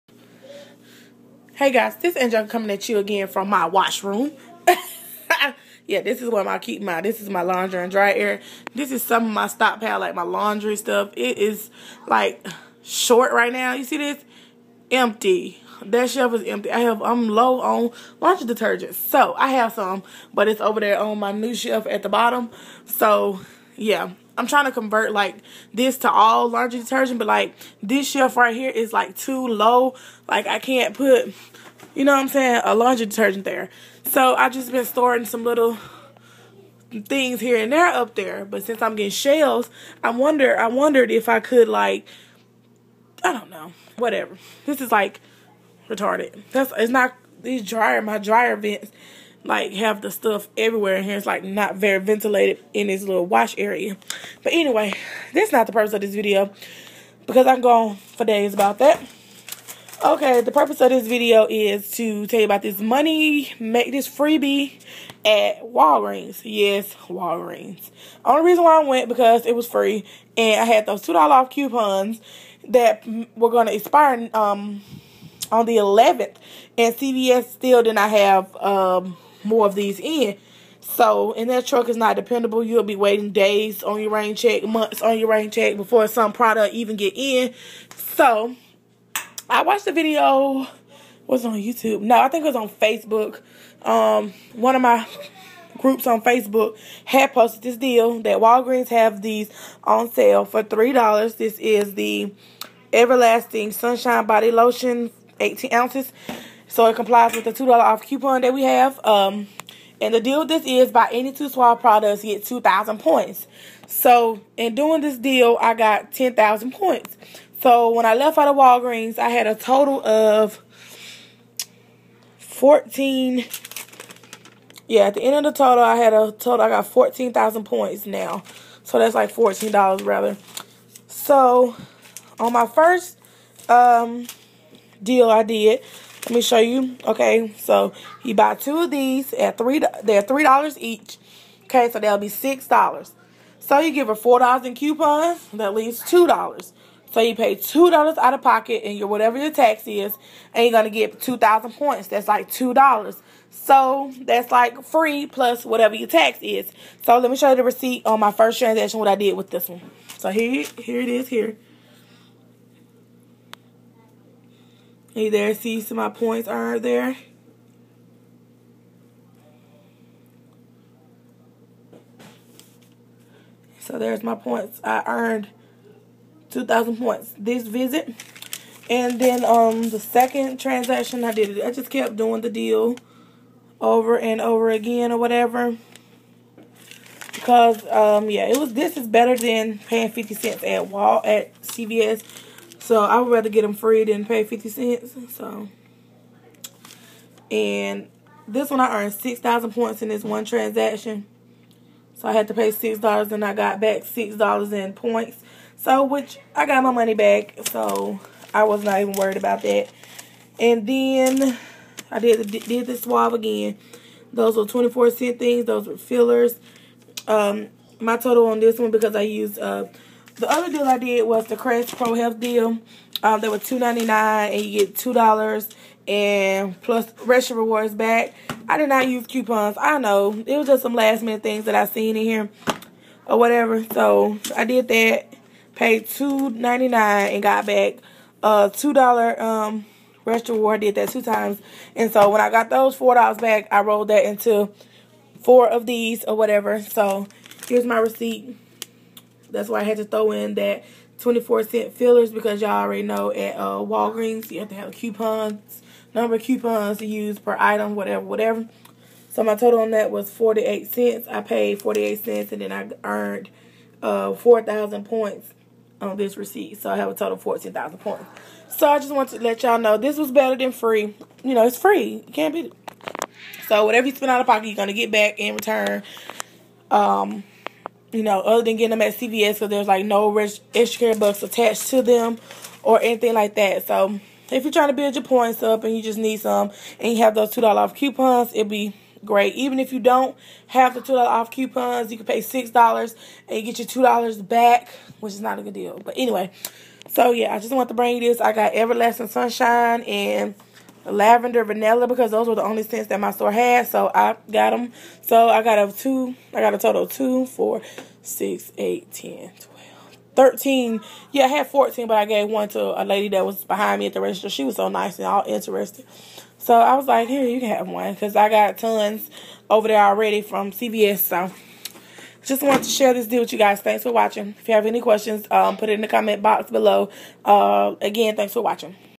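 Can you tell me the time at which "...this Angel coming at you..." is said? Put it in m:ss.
0:01.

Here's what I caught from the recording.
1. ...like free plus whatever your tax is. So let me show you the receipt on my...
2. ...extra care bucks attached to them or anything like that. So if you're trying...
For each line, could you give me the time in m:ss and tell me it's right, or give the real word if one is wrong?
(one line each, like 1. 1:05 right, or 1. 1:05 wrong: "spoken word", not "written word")
1. 2:34 right
2. 4:40 right.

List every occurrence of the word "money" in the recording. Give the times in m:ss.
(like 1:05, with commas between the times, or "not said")
1:02, 3:26.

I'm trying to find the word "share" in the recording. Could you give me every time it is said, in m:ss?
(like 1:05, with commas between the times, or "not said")
5:22.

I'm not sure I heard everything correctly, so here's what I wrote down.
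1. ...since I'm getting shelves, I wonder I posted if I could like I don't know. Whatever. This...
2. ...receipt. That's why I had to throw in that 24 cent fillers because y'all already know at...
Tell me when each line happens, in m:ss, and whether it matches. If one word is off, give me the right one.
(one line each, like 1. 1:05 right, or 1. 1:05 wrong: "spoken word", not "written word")
1. 0:38 wrong: "wondered", not "posted"
2. 4:07 right.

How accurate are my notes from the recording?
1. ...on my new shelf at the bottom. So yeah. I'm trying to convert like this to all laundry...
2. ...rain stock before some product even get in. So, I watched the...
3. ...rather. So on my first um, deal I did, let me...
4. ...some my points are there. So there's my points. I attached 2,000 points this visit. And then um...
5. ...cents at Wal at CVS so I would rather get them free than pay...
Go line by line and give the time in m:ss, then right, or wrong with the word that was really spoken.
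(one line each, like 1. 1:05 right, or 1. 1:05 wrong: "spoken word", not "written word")
1. 0:20 right
2. 1:25 wrong: "check", not "stock"
3. 2:10 right
4. 2:45 wrong: "earned", not "attached"
5. 3:10 right.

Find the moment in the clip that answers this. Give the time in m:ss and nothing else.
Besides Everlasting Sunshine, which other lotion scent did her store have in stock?
5:01.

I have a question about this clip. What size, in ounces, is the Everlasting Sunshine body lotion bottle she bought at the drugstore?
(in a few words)
18 ounces.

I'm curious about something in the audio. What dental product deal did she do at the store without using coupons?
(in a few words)
Crest Pro Health.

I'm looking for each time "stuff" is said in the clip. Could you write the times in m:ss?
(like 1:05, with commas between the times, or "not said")
0:10, 0:50.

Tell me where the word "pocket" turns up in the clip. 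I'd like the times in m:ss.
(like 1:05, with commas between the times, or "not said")
2:28, 4:34.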